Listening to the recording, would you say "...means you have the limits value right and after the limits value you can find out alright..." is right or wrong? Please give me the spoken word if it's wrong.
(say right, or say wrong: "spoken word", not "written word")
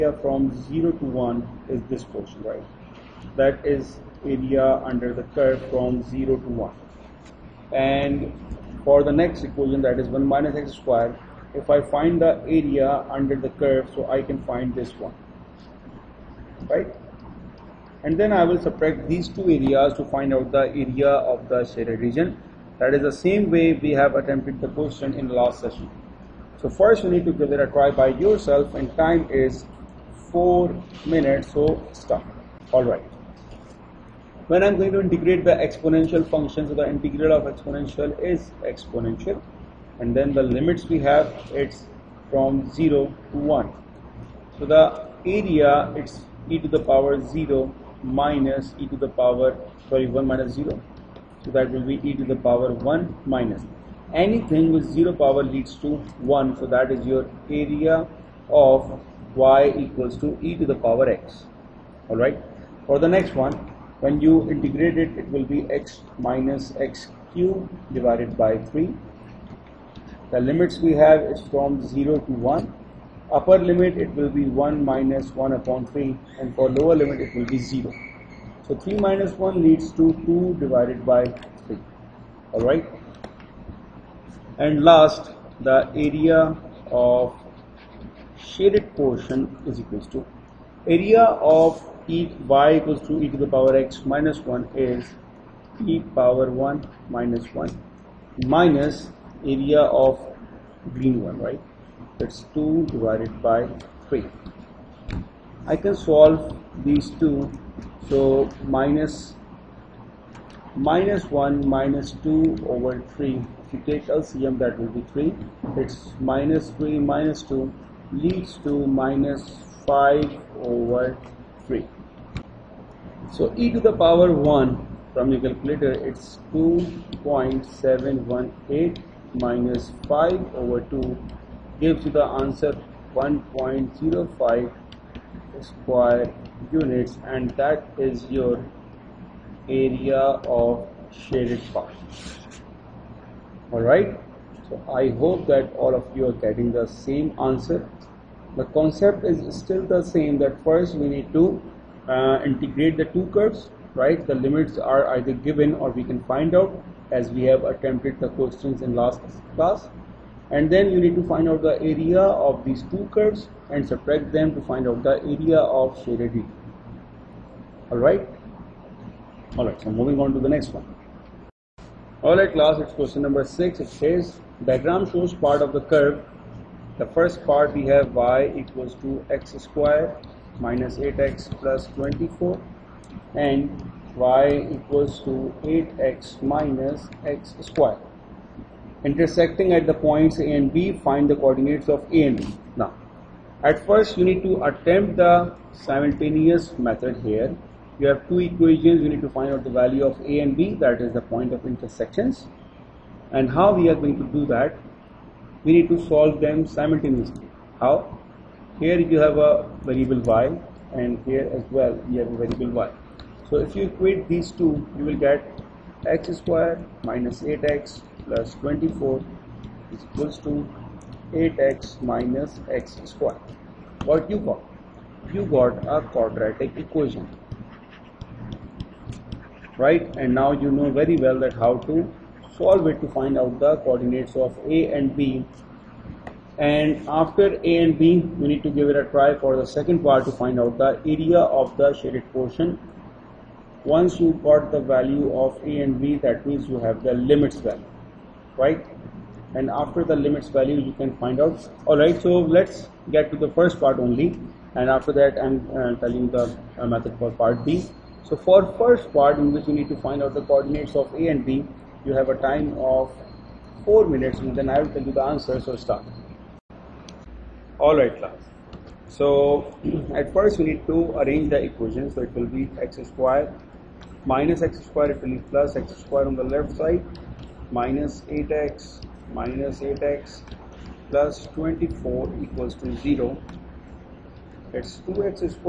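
right.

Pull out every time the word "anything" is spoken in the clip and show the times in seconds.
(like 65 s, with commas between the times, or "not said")
54 s.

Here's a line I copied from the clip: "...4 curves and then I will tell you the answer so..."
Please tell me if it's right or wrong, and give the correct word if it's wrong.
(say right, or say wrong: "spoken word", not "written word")
wrong: "minutes", not "curves".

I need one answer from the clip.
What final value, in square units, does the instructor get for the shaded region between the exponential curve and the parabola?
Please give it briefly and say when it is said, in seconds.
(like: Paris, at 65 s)
1.05, at 133 s.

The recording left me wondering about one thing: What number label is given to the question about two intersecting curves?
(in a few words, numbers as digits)
6.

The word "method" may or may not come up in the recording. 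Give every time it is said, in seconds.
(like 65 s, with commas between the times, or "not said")
196 s, 256 s.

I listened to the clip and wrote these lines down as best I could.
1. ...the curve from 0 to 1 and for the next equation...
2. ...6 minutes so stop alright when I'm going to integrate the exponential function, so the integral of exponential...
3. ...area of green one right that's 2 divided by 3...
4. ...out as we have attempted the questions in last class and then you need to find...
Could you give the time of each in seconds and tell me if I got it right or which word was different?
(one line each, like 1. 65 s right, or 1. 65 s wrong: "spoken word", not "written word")
1. 5 s right
2. 30 s wrong: "4", not "6"
3. 99 s right
4. 156 s right.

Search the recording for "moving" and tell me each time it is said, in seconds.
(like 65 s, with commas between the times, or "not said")
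169 s.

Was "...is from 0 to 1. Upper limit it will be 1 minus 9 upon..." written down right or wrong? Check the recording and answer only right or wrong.
wrong.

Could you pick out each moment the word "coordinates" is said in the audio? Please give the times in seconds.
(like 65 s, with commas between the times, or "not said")
191 s, 233 s, 260 s.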